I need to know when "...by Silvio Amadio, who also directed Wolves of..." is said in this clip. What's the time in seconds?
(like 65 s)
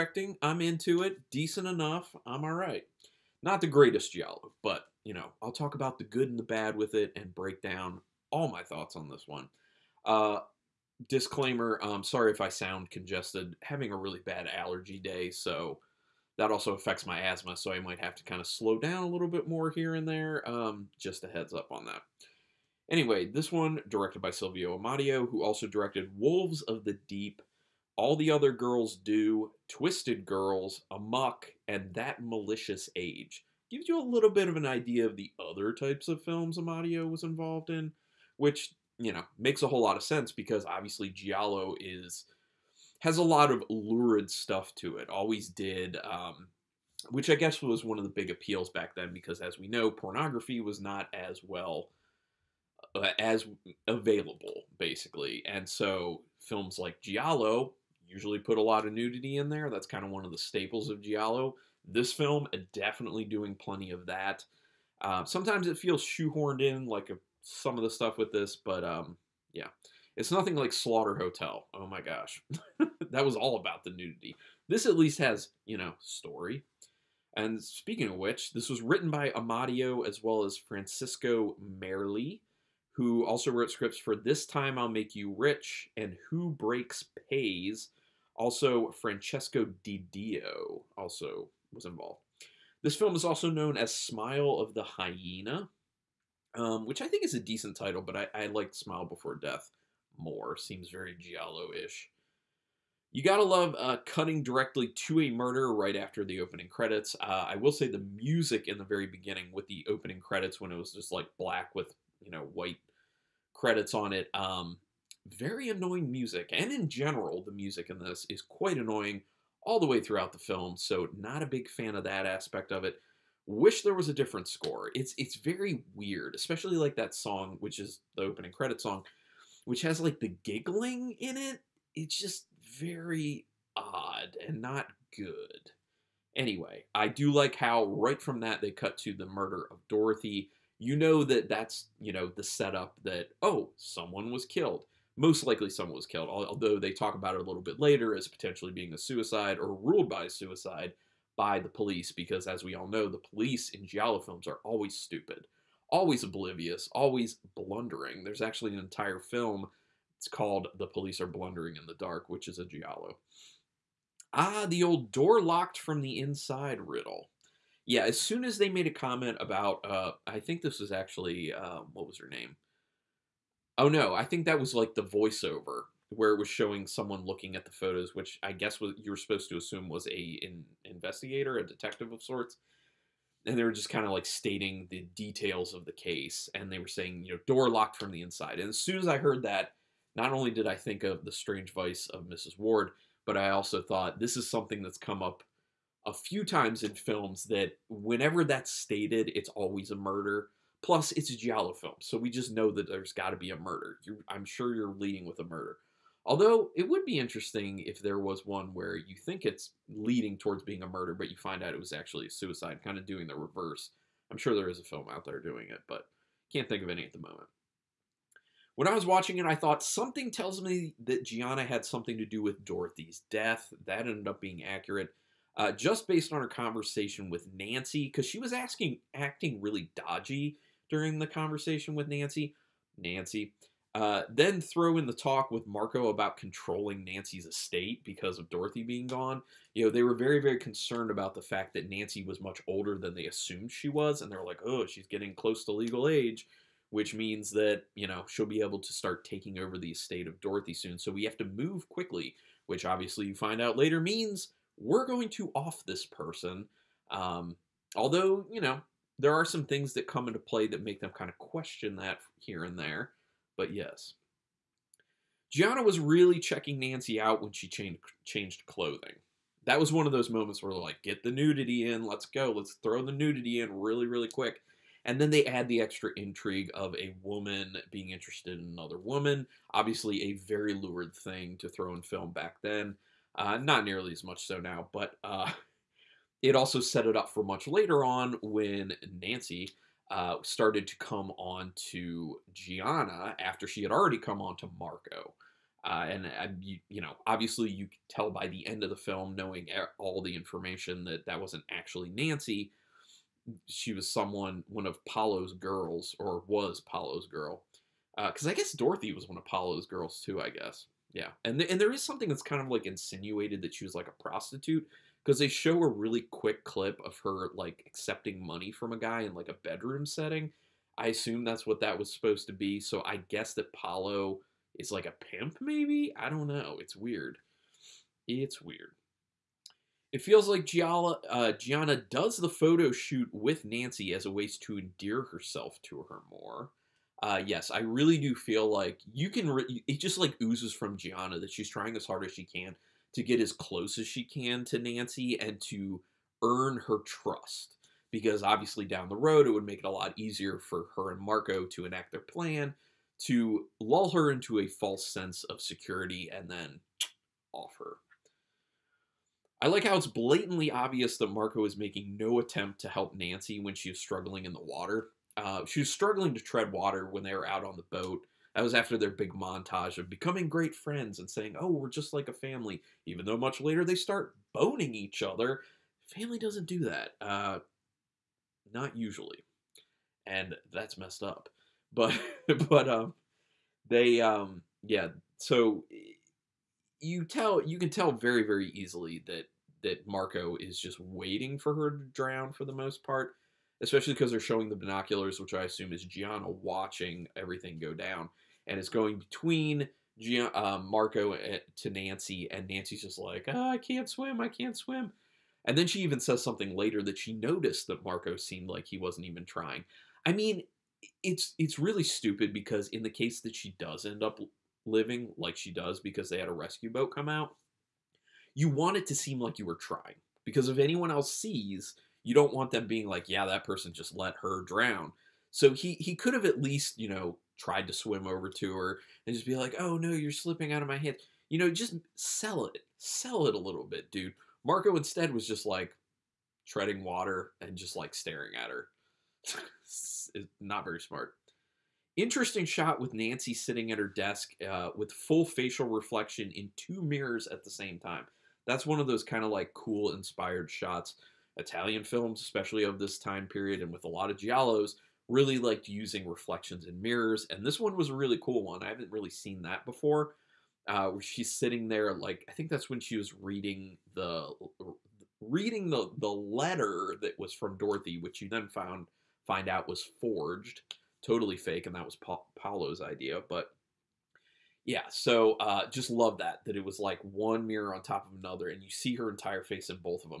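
24 s.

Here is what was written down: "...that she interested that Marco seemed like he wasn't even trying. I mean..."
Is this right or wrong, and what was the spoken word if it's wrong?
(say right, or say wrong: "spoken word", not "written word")
wrong: "noticed", not "interested".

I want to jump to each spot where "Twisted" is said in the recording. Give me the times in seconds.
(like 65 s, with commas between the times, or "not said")
29 s.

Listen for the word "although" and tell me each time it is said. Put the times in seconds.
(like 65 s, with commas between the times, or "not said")
146 s, 206 s, 257 s.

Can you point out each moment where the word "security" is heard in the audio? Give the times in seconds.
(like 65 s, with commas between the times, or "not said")
355 s.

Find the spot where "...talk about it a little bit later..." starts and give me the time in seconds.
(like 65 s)
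146 s.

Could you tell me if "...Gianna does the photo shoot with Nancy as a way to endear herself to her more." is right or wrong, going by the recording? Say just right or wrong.
right.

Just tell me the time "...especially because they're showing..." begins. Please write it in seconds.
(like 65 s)
393 s.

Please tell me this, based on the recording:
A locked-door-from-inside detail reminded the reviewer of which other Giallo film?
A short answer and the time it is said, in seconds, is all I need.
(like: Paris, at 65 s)
The Strange Vice of Mrs Ward, at 191 s.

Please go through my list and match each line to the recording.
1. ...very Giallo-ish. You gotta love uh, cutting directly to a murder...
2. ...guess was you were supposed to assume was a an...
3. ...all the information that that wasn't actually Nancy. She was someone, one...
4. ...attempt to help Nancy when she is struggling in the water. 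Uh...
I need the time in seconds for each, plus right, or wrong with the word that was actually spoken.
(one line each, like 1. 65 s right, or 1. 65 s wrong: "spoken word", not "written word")
1. 100 s right
2. 178 s right
3. 299 s right
4. 362 s right.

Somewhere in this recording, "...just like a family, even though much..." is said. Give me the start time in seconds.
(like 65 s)
371 s.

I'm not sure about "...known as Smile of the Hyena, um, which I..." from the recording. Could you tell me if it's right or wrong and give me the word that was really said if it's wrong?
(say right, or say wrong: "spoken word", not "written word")
right.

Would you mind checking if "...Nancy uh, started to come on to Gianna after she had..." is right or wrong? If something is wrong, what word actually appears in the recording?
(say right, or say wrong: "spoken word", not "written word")
right.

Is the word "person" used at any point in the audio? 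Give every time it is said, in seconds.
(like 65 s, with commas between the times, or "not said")
256 s, 423 s.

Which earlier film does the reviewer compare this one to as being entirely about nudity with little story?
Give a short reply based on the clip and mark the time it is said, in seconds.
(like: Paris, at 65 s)
Slaughter Hotel, at 70 s.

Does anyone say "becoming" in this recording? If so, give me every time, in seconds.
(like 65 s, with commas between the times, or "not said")
370 s.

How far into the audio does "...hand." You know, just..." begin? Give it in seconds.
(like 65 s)
430 s.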